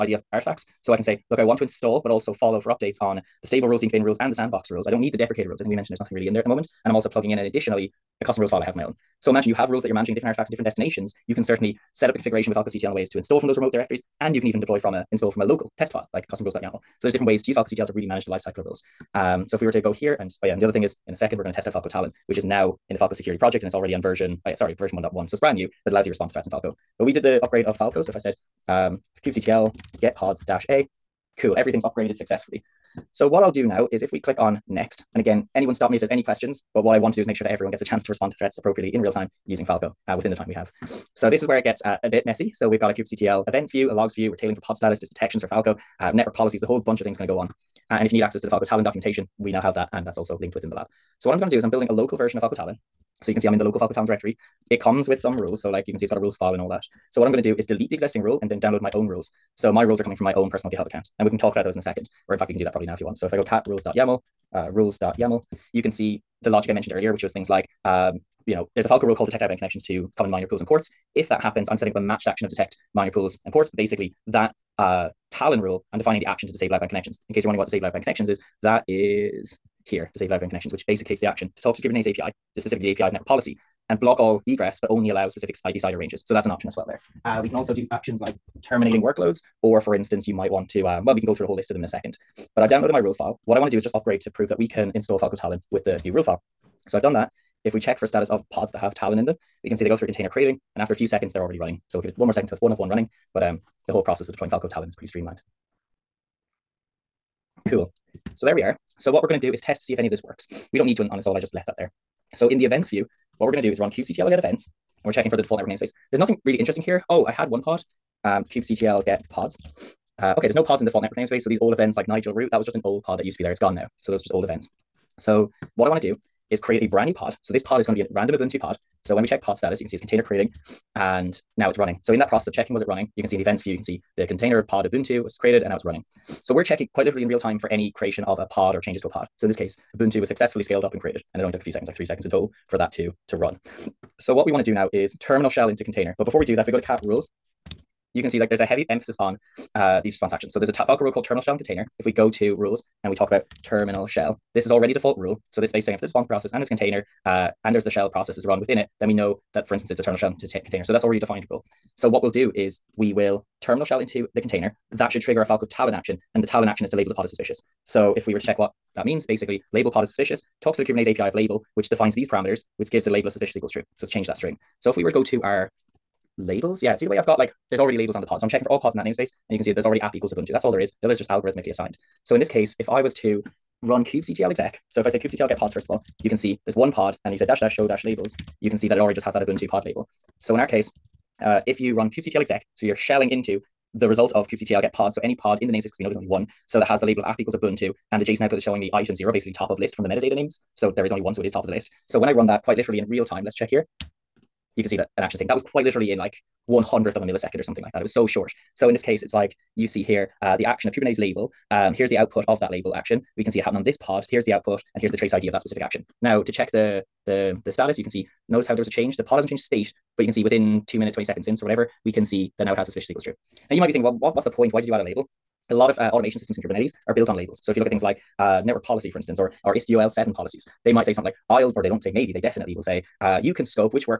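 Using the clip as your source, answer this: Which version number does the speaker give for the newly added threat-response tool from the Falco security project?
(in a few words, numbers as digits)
1.1.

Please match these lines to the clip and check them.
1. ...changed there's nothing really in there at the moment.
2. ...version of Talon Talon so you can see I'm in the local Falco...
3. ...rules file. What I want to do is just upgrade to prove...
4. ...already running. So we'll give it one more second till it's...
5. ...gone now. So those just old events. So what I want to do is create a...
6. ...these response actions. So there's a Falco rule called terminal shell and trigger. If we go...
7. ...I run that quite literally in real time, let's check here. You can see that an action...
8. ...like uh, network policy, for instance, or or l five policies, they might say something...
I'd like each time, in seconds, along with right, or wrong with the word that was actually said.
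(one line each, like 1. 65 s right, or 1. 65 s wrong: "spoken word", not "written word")
1. 5 s wrong: "mentioned", not "changed"
2. 52 s wrong: "Falco", not "Talon"
3. 92 s right
4. 101 s right
5. 123 s right
6. 150 s wrong: "container", not "trigger"
7. 202 s right
8. 228 s wrong: "seven", not "five".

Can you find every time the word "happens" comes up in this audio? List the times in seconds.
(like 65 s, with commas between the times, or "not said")
71 s, 213 s.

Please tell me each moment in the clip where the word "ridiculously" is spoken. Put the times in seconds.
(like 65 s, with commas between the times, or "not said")
not said.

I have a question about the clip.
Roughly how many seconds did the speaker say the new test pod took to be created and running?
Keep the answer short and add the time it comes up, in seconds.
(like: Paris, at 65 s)
3, at 141 s.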